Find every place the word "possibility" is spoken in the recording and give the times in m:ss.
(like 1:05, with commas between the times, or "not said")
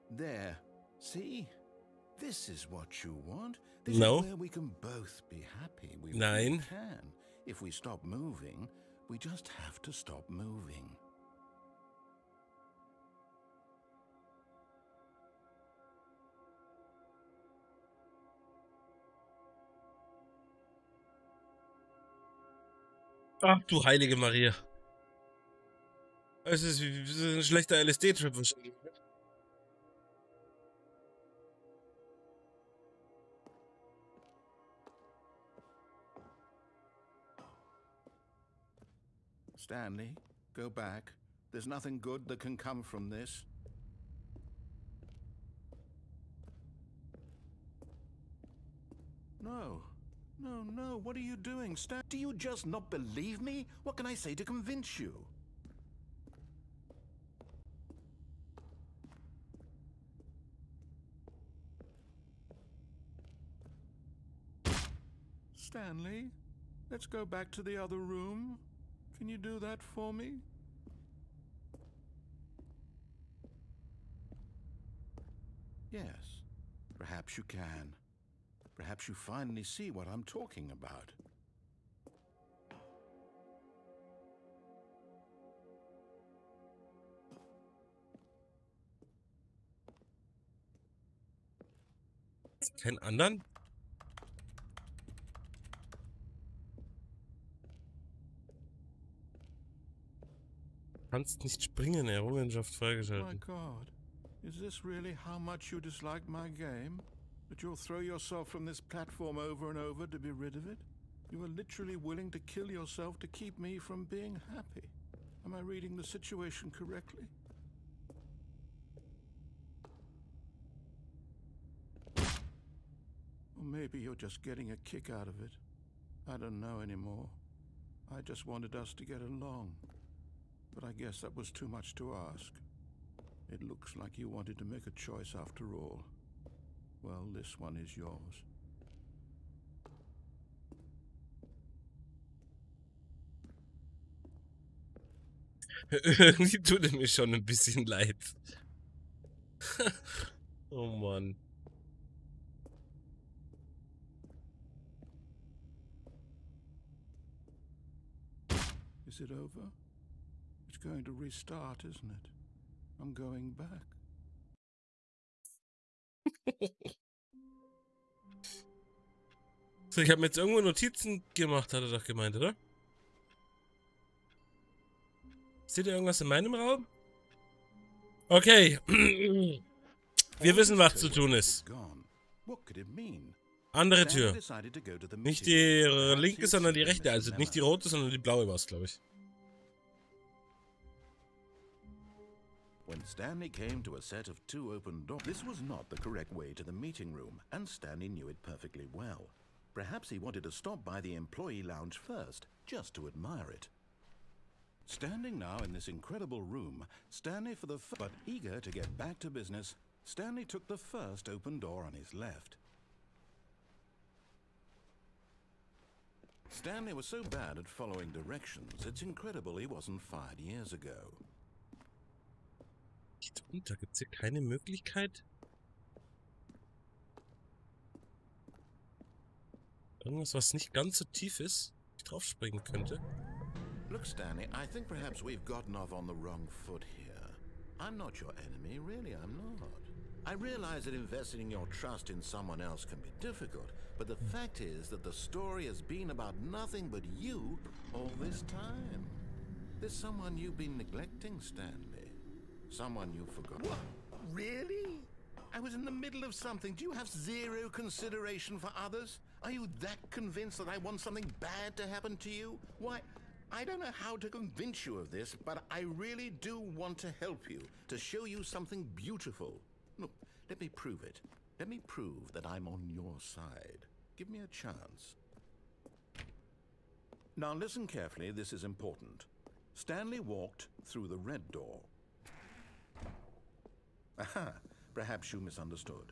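not said.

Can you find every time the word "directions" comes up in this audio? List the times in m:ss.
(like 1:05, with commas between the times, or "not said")
3:38.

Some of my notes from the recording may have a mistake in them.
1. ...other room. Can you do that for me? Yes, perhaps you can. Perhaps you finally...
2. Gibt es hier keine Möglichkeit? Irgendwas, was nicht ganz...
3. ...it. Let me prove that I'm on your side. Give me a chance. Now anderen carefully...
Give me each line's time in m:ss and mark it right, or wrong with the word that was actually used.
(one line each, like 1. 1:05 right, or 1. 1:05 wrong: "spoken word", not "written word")
1. 1:07 right
2. 3:43 right
3. 4:31 wrong: "listen", not "anderen".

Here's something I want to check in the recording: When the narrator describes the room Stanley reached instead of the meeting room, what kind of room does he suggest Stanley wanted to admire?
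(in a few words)
employee lounge.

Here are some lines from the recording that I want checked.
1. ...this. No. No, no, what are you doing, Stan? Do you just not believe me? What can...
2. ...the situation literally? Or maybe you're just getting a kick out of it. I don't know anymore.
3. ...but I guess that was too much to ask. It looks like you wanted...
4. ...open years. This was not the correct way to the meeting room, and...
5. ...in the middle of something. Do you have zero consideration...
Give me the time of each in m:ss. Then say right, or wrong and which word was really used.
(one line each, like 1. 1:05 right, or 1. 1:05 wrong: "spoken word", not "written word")
1. 0:43 right
2. 1:55 wrong: "correctly", not "literally"
3. 2:10 right
4. 3:14 wrong: "doors", not "years"
5. 4:15 right.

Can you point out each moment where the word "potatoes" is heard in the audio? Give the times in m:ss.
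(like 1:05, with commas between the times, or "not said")
not said.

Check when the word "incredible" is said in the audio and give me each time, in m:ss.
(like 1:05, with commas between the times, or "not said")
3:25, 3:39.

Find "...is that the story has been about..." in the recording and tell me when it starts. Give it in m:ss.
4:04.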